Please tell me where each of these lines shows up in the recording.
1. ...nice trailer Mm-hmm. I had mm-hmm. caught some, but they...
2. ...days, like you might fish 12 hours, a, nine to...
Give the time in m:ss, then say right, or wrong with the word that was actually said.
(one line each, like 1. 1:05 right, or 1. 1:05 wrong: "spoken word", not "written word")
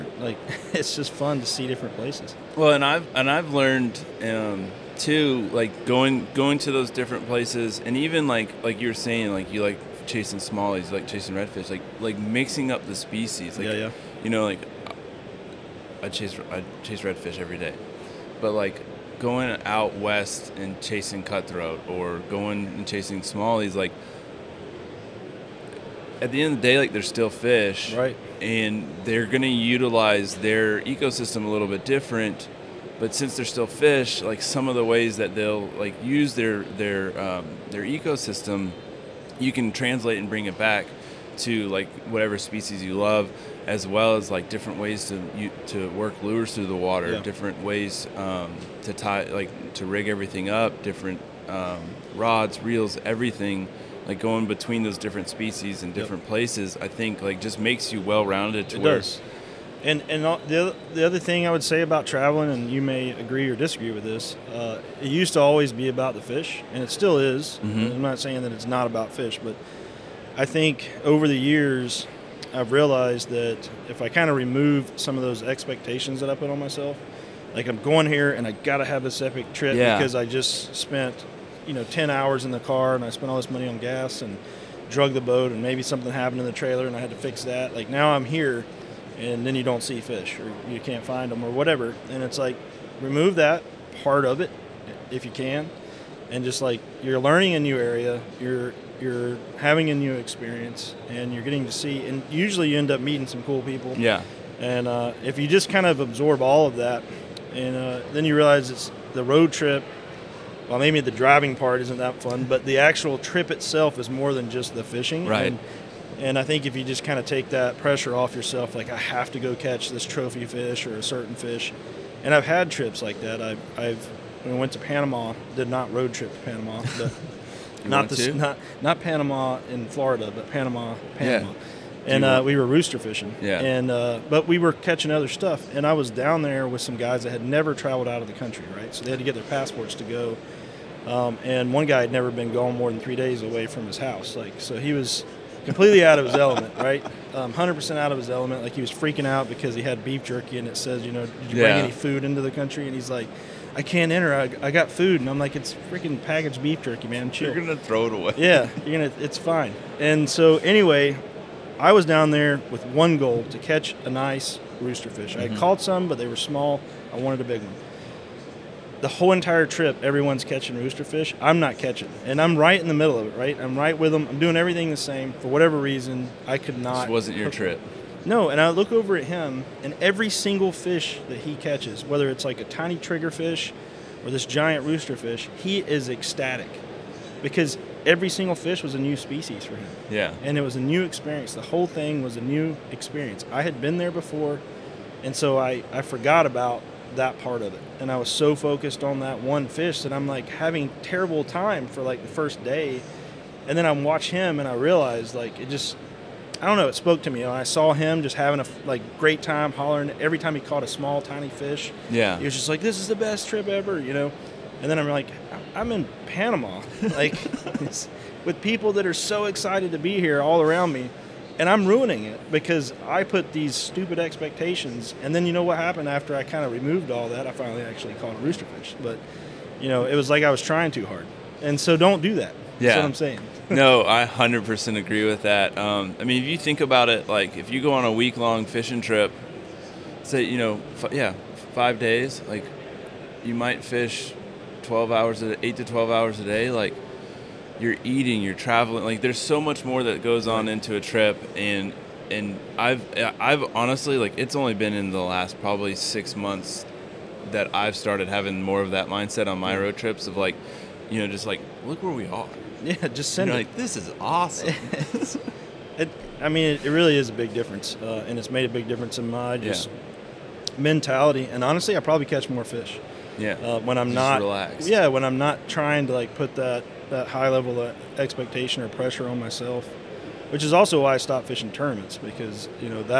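1. 2:44 wrong: "rooster", not "trailer"
2. 4:01 wrong: "eight", not "nine".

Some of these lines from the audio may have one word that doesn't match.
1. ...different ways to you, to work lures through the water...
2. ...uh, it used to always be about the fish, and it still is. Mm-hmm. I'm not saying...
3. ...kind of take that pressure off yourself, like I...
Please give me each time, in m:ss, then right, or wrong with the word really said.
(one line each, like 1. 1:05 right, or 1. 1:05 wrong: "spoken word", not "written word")
1. 0:44 right
2. 1:04 right
3. 1:57 right.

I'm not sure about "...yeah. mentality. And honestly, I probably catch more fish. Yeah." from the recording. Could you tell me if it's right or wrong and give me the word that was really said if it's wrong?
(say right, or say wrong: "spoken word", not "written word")
right.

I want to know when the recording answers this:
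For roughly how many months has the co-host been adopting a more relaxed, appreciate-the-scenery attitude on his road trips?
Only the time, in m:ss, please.
4:15.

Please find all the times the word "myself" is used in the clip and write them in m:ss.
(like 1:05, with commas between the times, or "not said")
1:16, 4:39.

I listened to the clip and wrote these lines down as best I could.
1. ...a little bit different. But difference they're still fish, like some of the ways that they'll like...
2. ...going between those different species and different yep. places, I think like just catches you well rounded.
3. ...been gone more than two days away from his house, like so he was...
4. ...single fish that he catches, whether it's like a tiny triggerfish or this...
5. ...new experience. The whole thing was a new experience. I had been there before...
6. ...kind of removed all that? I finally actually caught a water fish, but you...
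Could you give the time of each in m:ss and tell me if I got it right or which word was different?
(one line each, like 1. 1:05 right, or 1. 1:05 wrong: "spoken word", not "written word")
1. 0:31 wrong: "since", not "difference"
2. 0:54 wrong: "makes", not "catches"
3. 2:22 wrong: "three", not "two"
4. 3:00 right
5. 3:10 right
6. 3:46 wrong: "rooster", not "water".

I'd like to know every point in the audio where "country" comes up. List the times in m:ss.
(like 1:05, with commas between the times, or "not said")
2:18, 2:32.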